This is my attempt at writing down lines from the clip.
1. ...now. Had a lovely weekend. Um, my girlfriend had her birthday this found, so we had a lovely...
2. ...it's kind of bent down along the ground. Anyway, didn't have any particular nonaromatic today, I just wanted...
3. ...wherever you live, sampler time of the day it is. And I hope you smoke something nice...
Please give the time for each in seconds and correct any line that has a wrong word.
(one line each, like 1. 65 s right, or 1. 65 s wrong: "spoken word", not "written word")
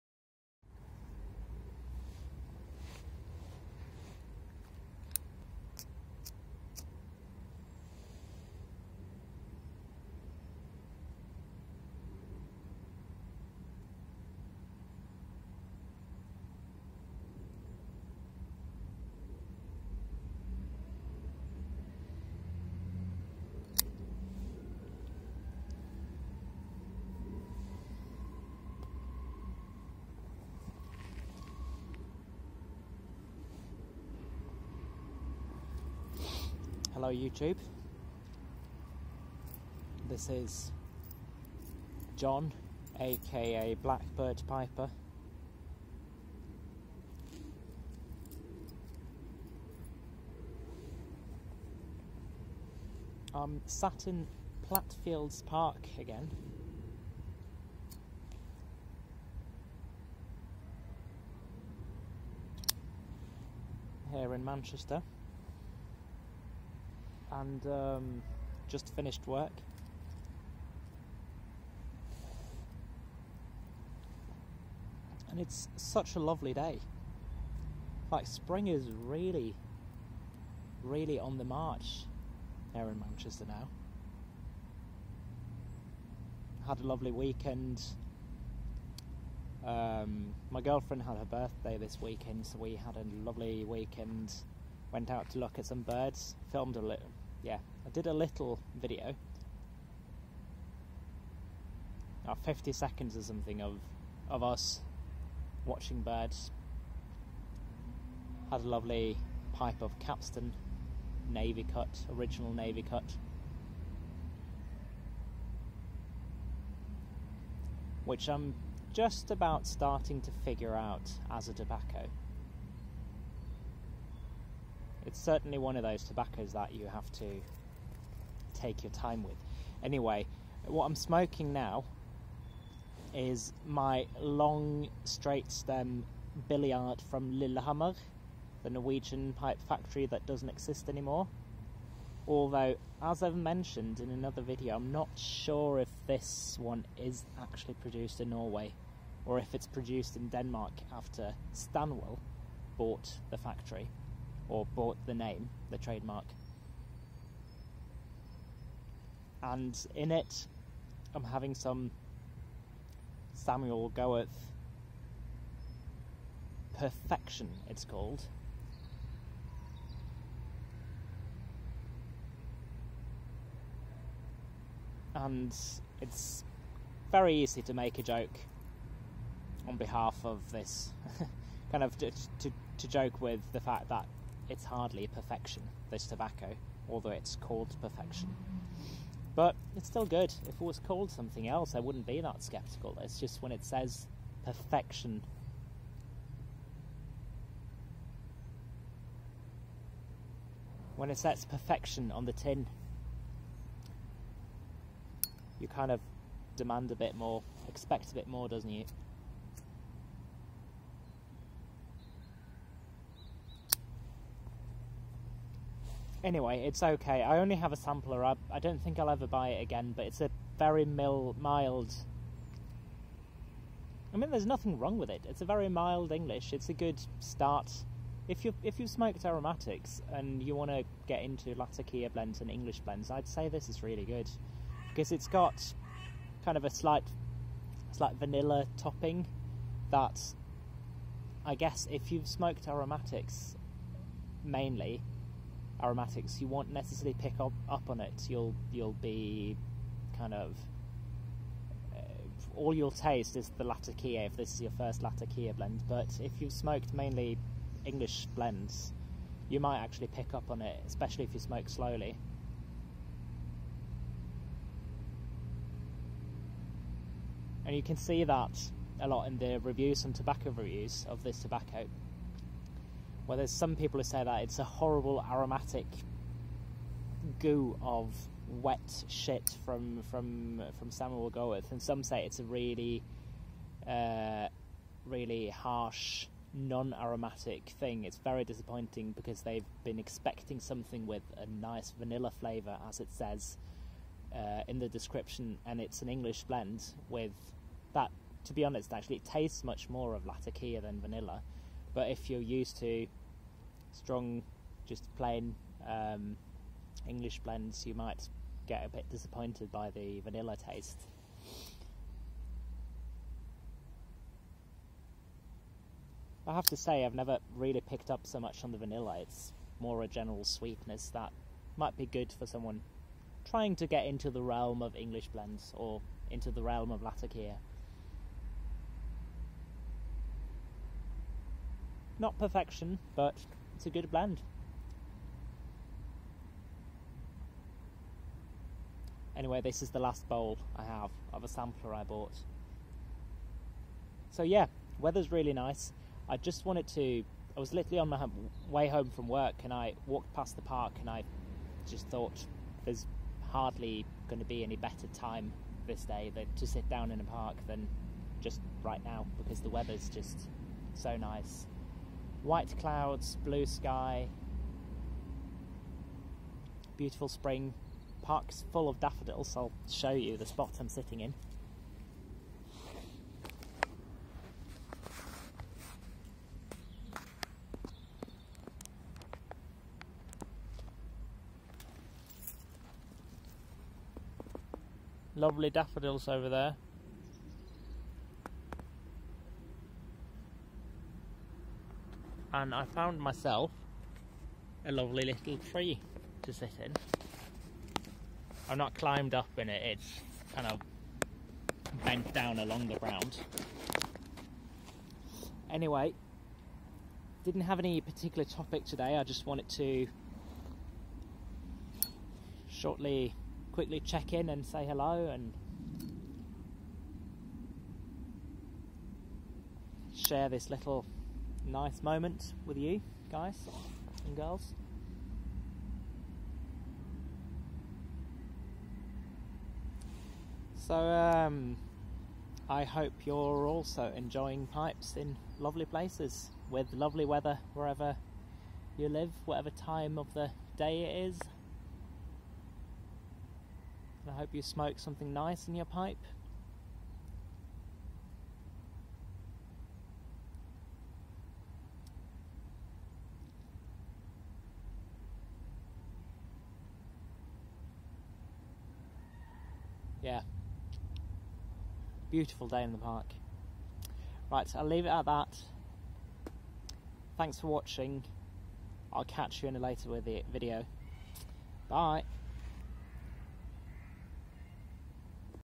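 1. 83 s wrong: "weekend", not "found"
2. 399 s wrong: "topic", not "nonaromatic"
3. 437 s wrong: "whatever", not "sampler".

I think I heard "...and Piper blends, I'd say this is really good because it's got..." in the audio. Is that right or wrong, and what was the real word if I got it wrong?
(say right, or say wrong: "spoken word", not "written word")
wrong: "English", not "Piper".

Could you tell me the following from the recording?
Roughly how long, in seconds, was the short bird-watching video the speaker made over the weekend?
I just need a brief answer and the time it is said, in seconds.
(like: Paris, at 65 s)
50, at 102 s.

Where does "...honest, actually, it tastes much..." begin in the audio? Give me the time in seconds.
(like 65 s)
298 s.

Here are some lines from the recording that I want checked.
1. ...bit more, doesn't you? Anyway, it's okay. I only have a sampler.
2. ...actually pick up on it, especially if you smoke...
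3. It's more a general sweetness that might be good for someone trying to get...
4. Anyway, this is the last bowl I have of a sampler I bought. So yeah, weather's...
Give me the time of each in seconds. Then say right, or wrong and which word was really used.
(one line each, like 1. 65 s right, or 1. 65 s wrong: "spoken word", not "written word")
1. 208 s right
2. 259 s right
3. 319 s right
4. 339 s right.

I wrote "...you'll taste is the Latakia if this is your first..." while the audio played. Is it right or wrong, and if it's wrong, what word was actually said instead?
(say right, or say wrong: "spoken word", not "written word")
right.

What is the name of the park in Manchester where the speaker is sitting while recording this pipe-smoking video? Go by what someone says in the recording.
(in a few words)
Platt Fields Park.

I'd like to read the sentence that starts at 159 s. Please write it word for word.
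And in it, I'm having some Samuel Gawith Perfection, it's called.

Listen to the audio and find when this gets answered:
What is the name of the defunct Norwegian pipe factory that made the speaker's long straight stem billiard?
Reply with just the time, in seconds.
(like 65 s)
137 s.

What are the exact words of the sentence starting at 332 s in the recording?
Not perfection, but it's a good blend.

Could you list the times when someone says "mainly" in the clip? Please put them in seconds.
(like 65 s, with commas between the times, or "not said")
244 s, 256 s.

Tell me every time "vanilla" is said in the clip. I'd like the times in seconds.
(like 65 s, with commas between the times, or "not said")
238 s, 291 s, 300 s, 310 s, 318 s.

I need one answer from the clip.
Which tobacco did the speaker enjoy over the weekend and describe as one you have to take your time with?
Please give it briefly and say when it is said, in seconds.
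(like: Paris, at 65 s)
Capstan Navy Cut, at 109 s.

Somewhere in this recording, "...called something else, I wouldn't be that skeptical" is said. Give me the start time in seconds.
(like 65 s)
190 s.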